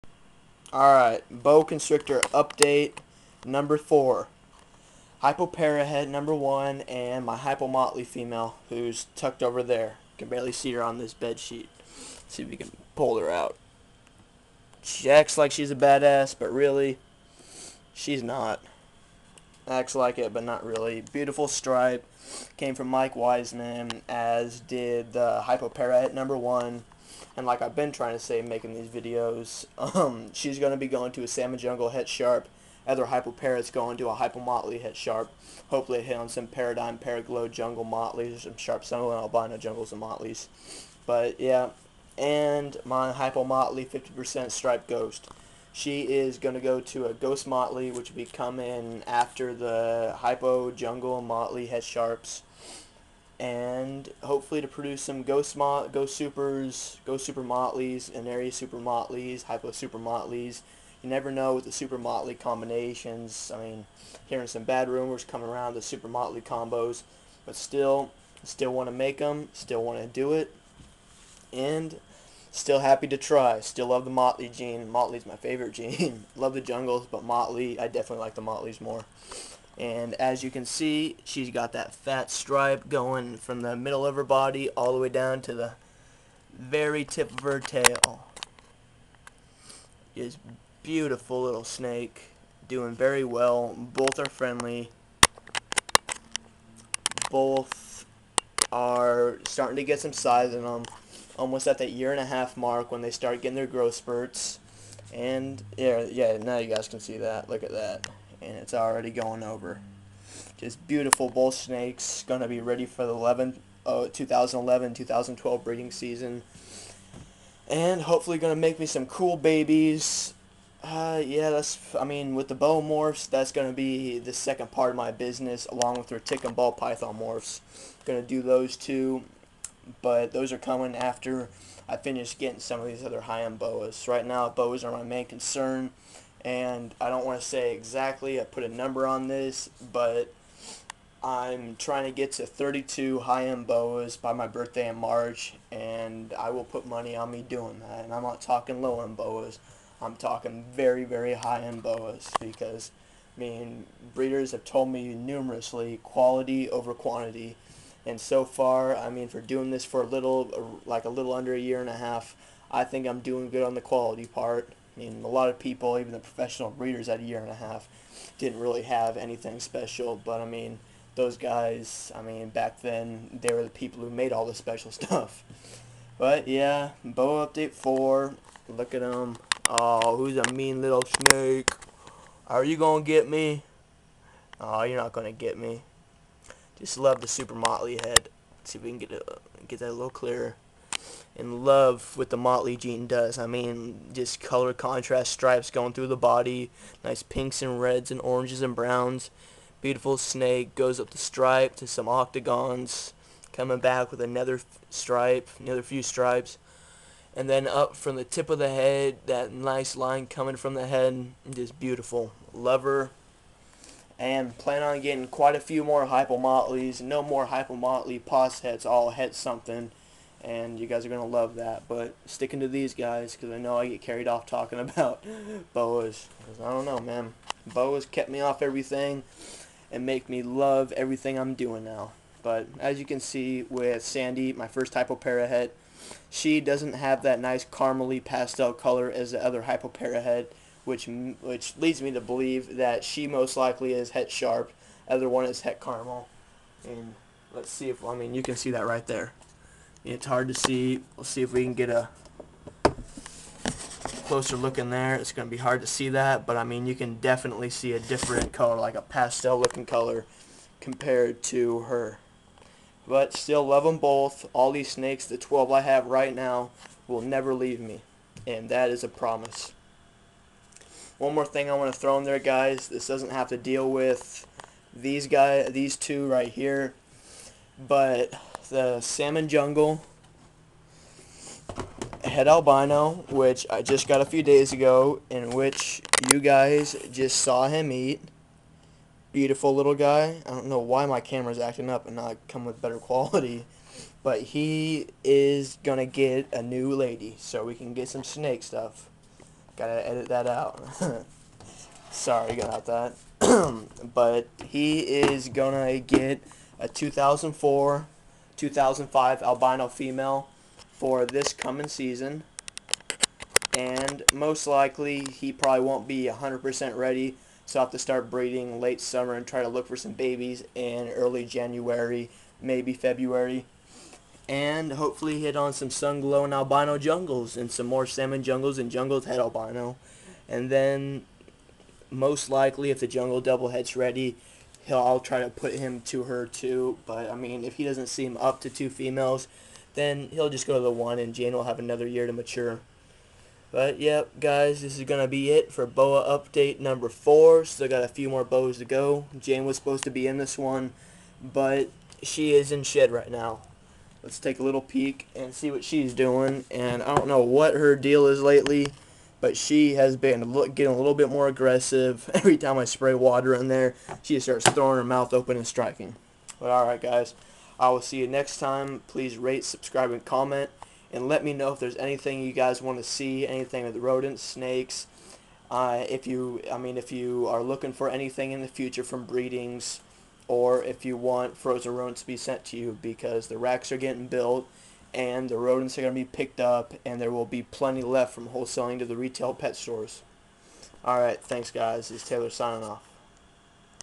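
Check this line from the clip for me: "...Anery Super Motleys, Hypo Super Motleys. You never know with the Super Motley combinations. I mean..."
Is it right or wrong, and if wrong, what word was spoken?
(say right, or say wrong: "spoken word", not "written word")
right.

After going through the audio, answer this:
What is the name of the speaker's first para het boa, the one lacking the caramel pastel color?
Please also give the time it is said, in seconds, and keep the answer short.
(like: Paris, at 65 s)
Sandy, at 234 s.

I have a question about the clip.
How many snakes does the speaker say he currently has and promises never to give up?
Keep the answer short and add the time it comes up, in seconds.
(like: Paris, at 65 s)
12, at 265 s.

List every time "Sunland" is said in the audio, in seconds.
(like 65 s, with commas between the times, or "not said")
38 s.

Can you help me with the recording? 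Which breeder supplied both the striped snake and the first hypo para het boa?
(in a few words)
Mike Weitzman.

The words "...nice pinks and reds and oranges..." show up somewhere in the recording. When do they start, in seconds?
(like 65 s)
197 s.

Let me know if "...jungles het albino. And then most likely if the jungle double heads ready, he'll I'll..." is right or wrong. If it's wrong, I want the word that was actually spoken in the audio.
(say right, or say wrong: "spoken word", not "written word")
right.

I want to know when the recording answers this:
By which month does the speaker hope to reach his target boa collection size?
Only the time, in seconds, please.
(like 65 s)
144 s.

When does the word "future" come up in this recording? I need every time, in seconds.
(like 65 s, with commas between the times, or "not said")
378 s.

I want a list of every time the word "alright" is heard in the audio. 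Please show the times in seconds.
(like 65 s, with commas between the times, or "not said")
0 s, 366 s, 391 s.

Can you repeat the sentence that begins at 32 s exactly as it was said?
Other Hypoparat's going to a Hypomotley Het Sharp.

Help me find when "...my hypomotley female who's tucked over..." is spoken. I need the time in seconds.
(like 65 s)
7 s.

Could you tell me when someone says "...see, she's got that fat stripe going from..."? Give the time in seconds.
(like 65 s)
80 s.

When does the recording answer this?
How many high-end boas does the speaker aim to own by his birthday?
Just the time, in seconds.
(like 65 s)
142 s.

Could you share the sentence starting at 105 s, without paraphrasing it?
And yeah, yeah, now you guys can see that.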